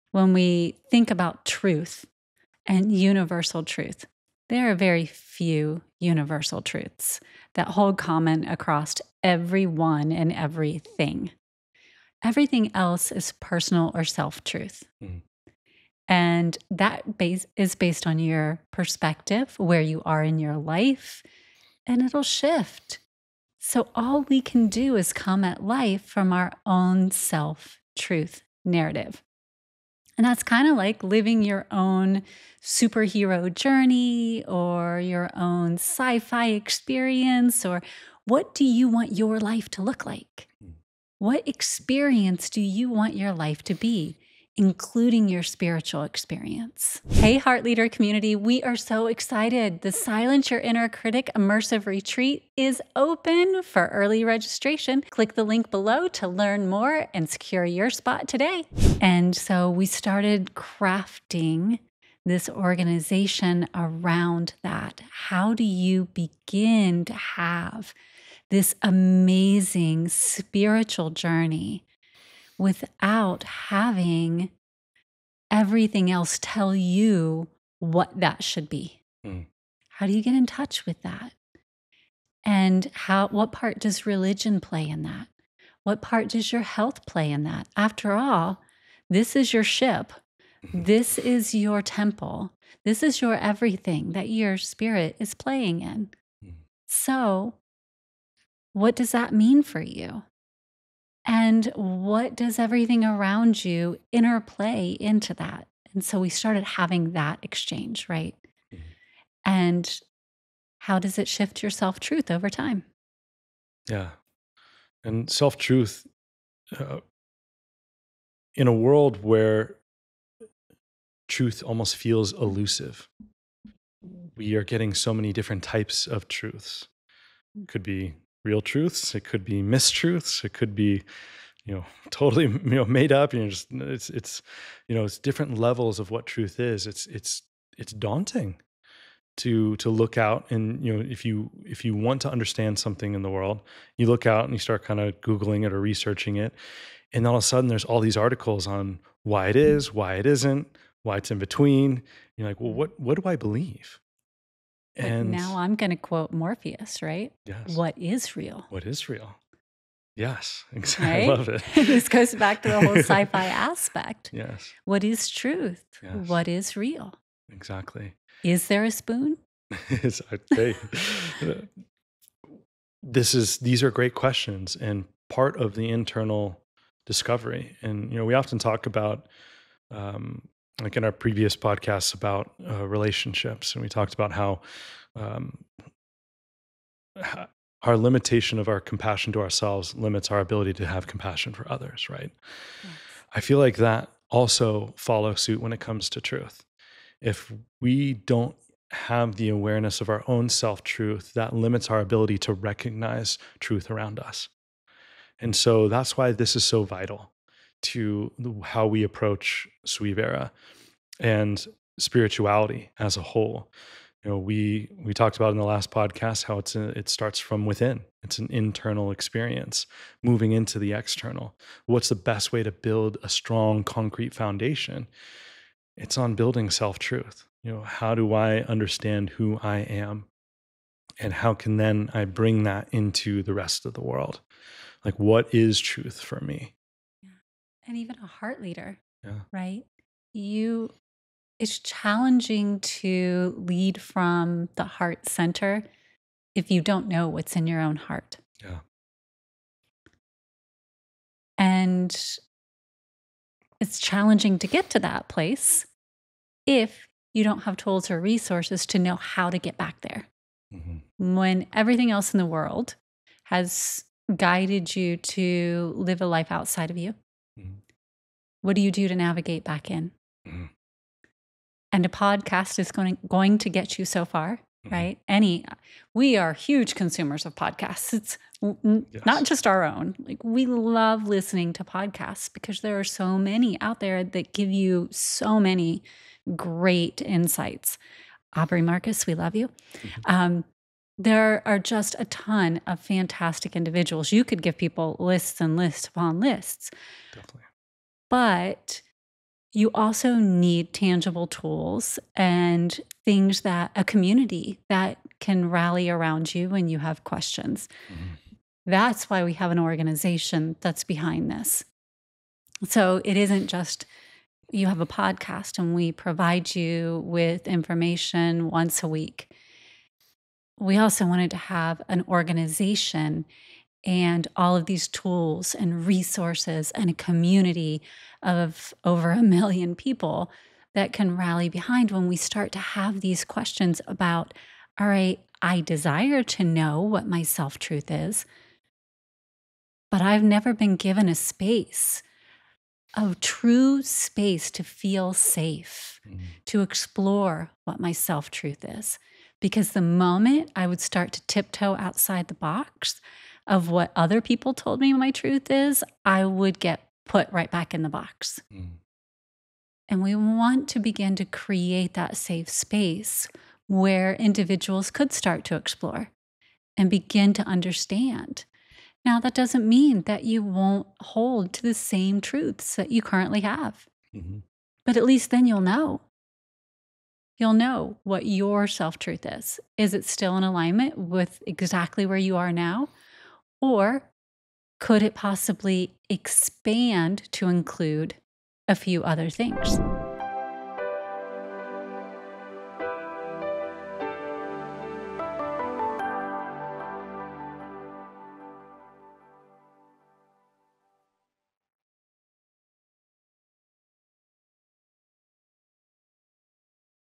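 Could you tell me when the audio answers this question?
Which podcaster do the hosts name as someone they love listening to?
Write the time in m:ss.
4:48.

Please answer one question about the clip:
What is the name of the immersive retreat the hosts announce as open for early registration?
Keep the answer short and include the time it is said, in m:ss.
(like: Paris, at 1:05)
Silence Your Inner Critic, at 0:49.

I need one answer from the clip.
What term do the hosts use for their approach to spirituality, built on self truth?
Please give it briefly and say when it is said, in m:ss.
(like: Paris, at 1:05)
sui vera, at 3:29.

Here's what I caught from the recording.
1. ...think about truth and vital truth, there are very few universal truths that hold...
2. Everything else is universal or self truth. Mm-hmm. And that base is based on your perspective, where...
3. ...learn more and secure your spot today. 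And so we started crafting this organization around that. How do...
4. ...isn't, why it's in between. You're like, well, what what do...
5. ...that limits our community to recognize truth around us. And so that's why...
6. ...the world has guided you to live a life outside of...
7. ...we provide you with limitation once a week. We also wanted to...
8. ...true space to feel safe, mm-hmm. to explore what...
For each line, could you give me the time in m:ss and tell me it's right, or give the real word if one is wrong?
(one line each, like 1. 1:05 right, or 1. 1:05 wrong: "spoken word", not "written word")
1. 0:00 wrong: "universal", not "vital"
2. 0:12 wrong: "personal", not "universal"
3. 0:56 right
4. 2:30 right
5. 3:21 wrong: "ability", not "community"
6. 4:22 right
7. 5:15 wrong: "information", not "limitation"
8. 5:43 right.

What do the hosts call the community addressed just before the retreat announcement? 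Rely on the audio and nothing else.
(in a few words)
Heart Leader community.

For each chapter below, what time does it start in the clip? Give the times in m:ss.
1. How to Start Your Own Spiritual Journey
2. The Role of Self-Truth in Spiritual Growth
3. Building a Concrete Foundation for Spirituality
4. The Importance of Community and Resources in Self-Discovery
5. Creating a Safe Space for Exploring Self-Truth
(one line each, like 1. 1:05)
1. 1:29
2. 2:52
3. 3:33
4. 4:55
5. 5:37.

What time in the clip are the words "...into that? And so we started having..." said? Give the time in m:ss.
1:44.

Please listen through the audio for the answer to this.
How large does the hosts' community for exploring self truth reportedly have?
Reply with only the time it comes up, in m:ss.
5:29.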